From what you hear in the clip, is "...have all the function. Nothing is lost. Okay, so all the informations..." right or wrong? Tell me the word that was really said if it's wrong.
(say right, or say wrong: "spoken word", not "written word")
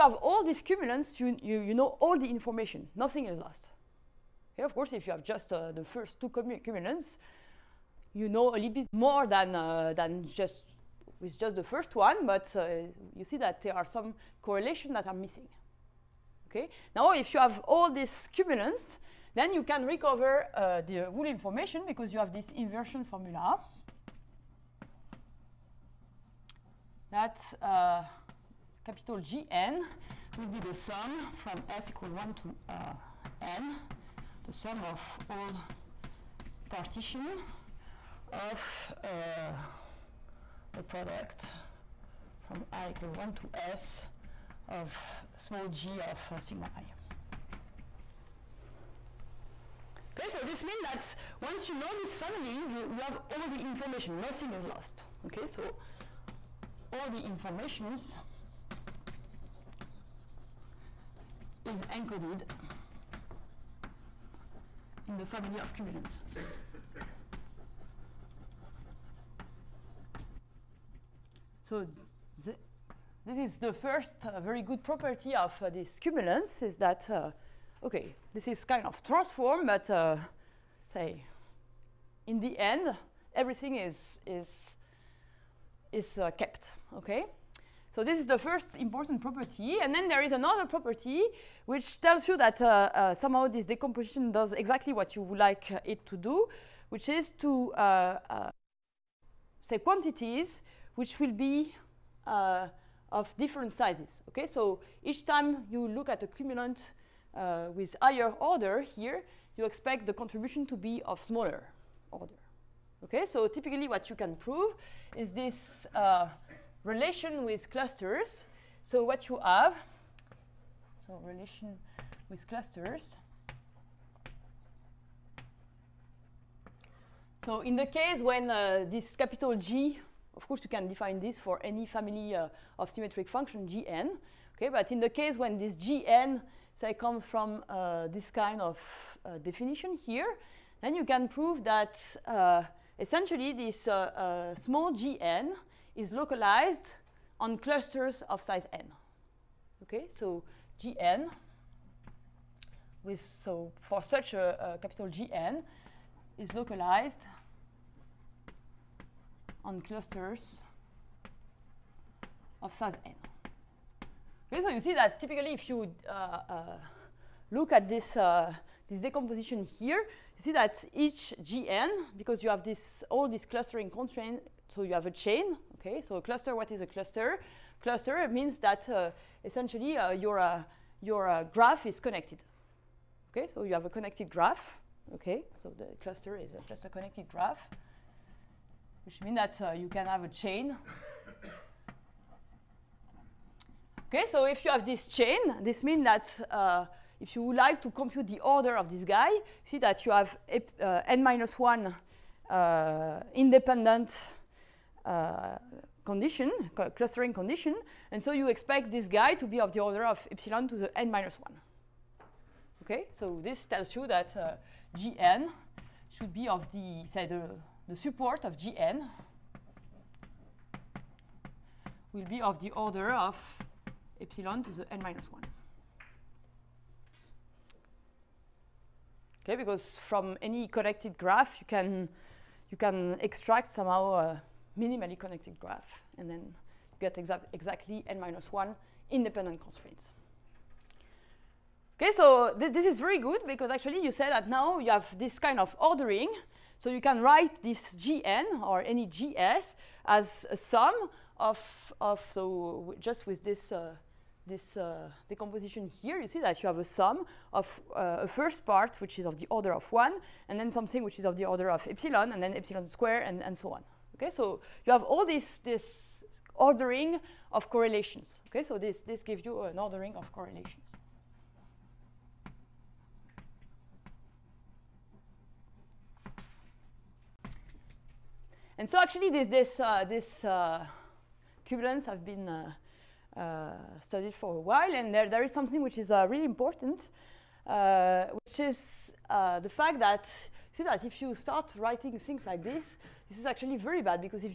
wrong: "information", not "function".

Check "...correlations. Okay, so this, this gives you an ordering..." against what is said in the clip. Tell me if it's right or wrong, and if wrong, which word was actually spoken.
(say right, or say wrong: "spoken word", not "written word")
right.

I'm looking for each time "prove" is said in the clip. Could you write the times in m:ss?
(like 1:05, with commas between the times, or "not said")
1:54, 2:21.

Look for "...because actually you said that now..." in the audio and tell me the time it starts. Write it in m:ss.
4:03.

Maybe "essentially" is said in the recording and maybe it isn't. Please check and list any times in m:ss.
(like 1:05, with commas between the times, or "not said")
2:22, 2:59.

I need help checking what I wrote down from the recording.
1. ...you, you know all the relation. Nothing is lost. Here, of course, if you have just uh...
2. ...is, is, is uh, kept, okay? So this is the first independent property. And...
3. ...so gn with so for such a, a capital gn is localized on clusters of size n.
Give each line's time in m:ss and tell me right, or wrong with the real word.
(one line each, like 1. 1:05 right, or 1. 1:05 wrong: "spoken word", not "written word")
1. 0:01 wrong: "information", not "relation"
2. 1:23 wrong: "important", not "independent"
3. 2:30 right.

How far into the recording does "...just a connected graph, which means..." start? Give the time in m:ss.
3:06.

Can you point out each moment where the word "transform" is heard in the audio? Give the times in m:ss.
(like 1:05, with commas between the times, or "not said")
1:19.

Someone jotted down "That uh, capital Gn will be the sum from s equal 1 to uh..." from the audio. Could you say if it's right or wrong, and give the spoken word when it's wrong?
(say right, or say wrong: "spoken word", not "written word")
right.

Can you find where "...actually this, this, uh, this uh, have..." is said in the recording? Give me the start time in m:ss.
4:38.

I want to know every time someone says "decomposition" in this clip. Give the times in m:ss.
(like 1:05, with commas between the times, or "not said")
1:33, 2:49, 4:15.